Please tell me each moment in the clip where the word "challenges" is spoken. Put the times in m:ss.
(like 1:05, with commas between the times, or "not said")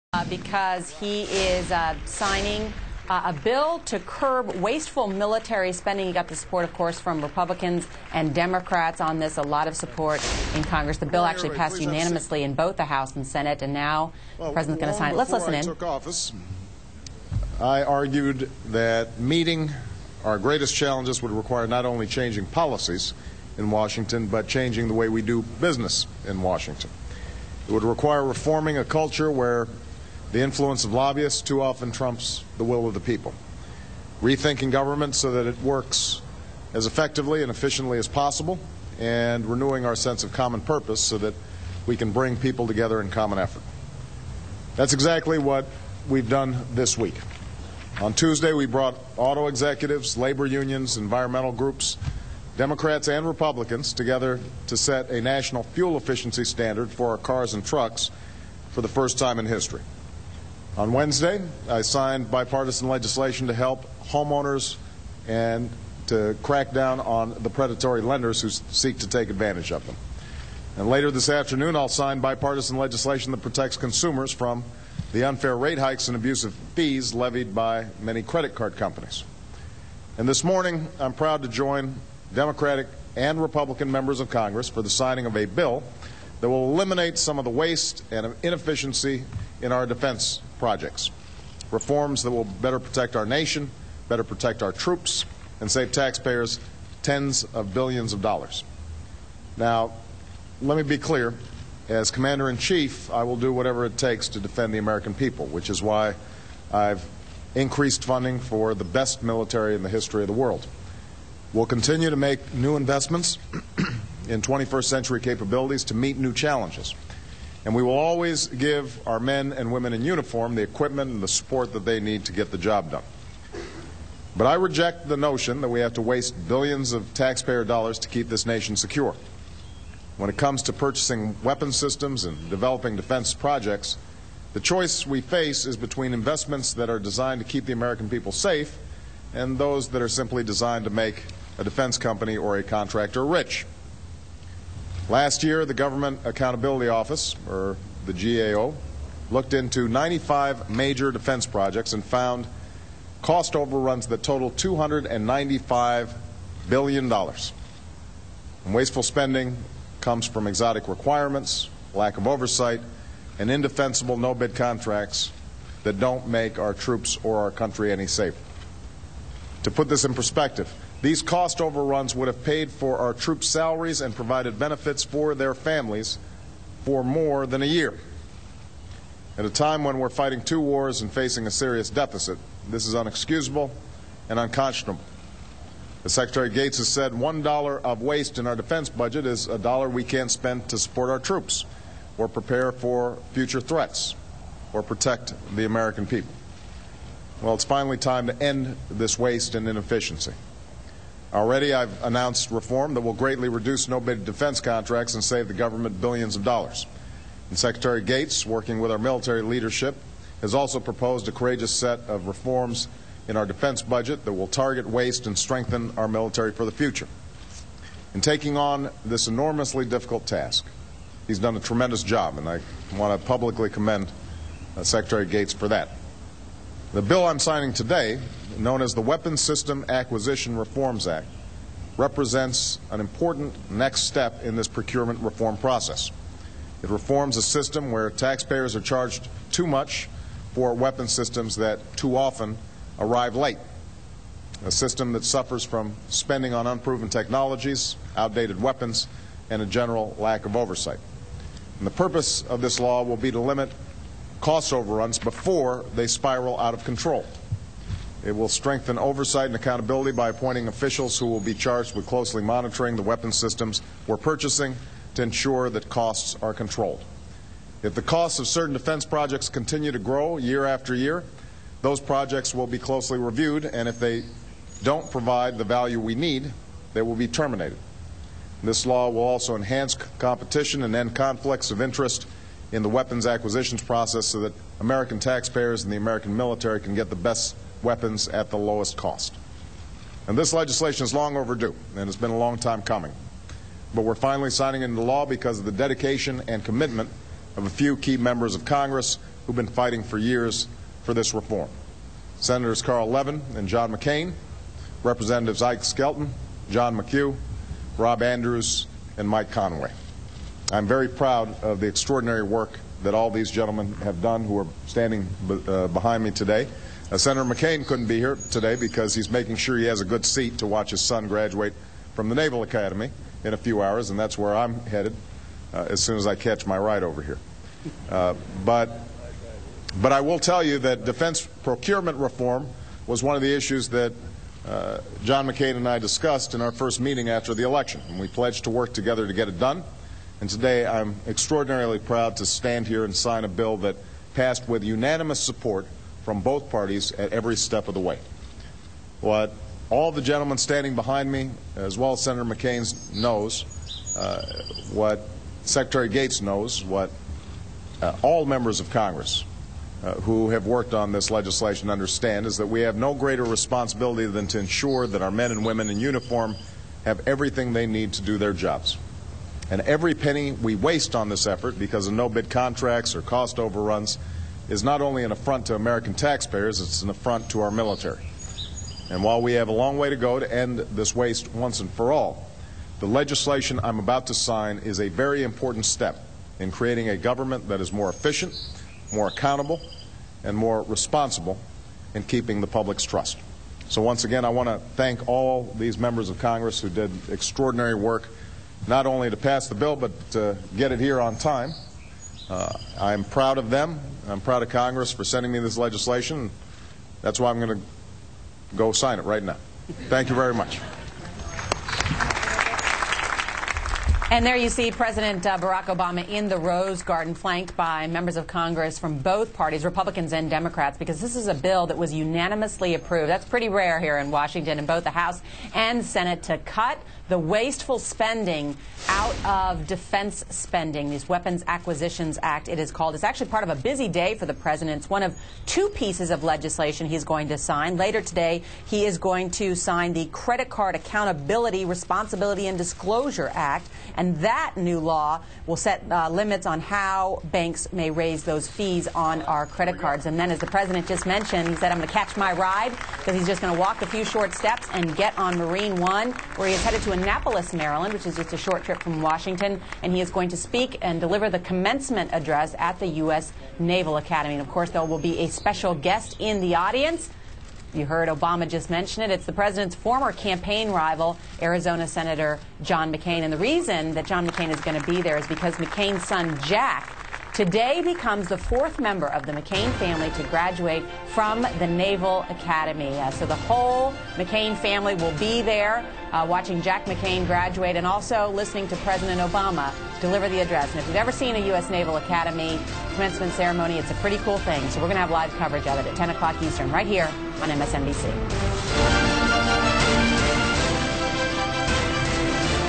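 0:20, 1:56.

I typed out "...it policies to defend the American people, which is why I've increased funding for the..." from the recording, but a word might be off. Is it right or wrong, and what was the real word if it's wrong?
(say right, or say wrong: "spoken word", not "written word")
wrong: "takes", not "policies".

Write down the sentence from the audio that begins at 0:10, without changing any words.
The bill actually passed unanimously in both the House and Senate, and now well, the President's going to sign it.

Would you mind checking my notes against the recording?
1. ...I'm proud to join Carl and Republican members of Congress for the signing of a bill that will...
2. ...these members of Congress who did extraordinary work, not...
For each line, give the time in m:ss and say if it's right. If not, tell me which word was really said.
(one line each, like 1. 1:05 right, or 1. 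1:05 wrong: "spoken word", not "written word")
1. 1:21 wrong: "Democratic", not "Carl"
2. 6:35 right.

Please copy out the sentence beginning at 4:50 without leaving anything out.
And this legislation is long overdue, and it's been a long time coming.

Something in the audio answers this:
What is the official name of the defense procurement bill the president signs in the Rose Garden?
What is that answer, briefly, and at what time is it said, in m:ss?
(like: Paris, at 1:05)
Weapons System Acquisition Reforms Act, at 3:49.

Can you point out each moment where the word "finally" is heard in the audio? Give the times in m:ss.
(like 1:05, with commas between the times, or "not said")
3:17, 4:54.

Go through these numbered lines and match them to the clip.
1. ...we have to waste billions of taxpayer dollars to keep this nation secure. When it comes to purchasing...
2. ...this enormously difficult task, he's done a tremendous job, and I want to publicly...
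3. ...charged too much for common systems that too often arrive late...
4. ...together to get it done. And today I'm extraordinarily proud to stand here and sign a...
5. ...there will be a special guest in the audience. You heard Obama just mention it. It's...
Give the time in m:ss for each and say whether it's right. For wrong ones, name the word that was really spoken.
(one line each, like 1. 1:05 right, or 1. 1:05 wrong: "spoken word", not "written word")
1. 2:05 right
2. 3:39 right
3. 3:58 wrong: "weapon", not "common"
4. 5:38 right
5. 7:44 right.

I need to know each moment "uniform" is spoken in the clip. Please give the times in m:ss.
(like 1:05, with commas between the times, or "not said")
2:00, 6:05.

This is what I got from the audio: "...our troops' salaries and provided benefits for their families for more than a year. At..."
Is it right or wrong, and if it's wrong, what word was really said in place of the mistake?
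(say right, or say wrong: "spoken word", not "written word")
right.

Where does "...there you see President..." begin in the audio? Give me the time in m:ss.
6:54.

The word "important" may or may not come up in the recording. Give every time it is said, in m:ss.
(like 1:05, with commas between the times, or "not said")
3:52, 6:25.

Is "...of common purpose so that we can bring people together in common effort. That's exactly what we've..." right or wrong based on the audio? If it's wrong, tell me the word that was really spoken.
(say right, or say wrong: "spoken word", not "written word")
right.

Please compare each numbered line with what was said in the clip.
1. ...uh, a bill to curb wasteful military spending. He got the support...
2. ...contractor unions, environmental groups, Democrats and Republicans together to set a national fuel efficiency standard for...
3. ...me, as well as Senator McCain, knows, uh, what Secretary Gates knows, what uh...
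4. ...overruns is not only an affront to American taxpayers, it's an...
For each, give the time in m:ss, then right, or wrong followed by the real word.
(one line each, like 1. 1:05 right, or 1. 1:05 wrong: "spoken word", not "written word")
1. 0:03 right
2. 0:50 wrong: "labor", not "contractor"
3. 5:51 right
4. 6:13 right.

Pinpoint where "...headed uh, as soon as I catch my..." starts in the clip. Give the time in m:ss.
5:24.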